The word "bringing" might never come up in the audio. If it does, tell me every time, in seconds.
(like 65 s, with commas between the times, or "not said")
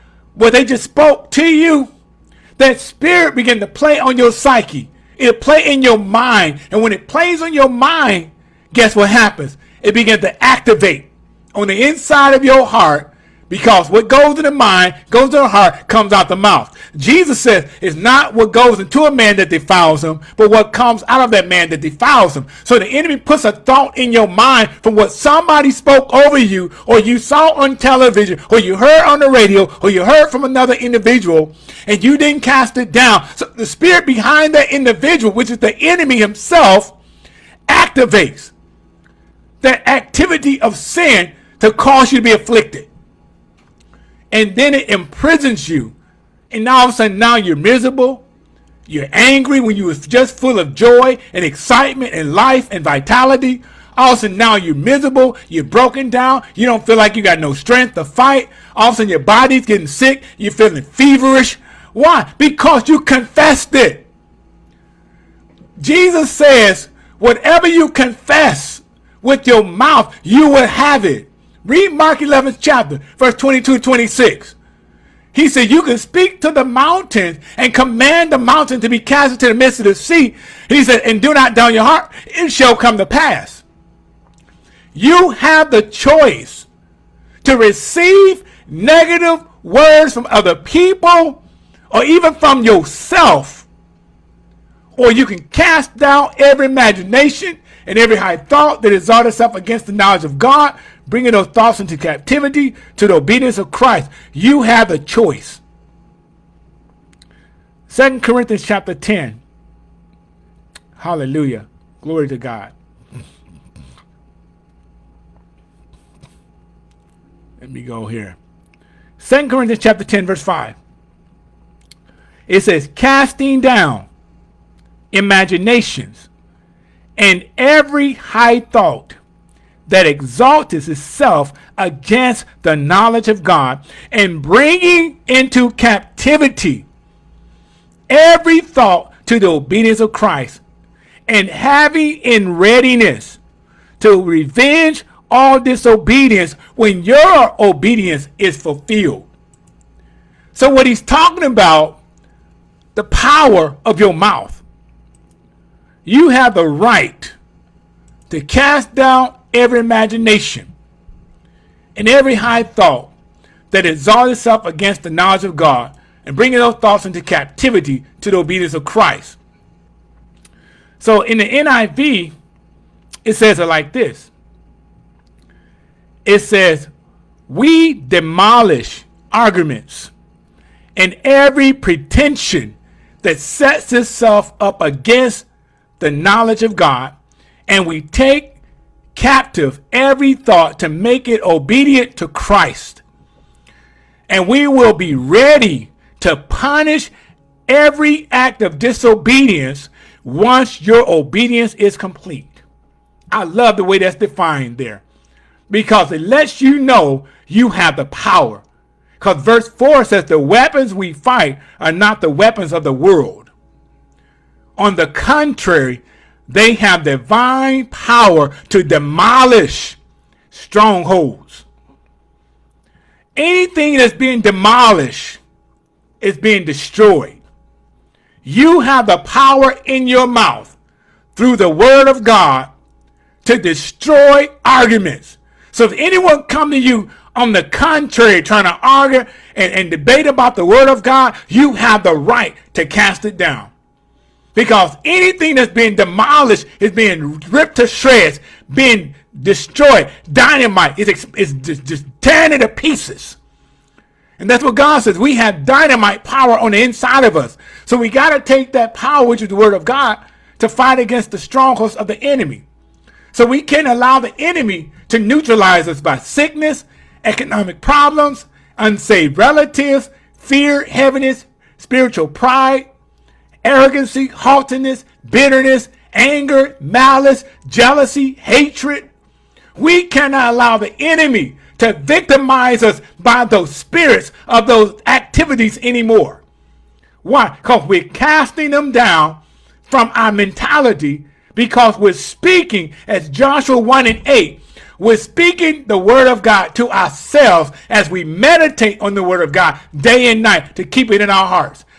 101 s, 134 s, 166 s.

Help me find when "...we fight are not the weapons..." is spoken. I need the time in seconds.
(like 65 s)
210 s.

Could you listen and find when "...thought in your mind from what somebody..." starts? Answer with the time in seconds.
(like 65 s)
23 s.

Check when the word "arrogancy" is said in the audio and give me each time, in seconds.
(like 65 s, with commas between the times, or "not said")
273 s.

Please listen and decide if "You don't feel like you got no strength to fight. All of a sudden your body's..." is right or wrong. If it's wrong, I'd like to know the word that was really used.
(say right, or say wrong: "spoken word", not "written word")
right.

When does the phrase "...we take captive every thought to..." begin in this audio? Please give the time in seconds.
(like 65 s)
187 s.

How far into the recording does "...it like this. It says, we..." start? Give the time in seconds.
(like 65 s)
173 s.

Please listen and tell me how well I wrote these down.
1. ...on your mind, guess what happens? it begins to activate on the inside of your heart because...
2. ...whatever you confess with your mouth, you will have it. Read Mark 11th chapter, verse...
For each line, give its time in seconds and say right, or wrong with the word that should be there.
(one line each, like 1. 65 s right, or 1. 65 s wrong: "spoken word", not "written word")
1. 7 s right
2. 67 s right.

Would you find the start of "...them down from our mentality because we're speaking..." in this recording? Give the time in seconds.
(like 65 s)
288 s.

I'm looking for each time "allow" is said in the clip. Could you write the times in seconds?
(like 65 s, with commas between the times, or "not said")
263 s, 280 s.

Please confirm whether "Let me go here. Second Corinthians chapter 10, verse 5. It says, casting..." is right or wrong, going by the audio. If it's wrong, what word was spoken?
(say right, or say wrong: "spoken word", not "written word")
right.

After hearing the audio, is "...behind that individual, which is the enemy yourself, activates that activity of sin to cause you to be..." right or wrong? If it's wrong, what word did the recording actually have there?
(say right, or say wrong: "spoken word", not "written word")
wrong: "himself", not "yourself".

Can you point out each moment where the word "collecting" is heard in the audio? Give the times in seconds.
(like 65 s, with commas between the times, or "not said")
not said.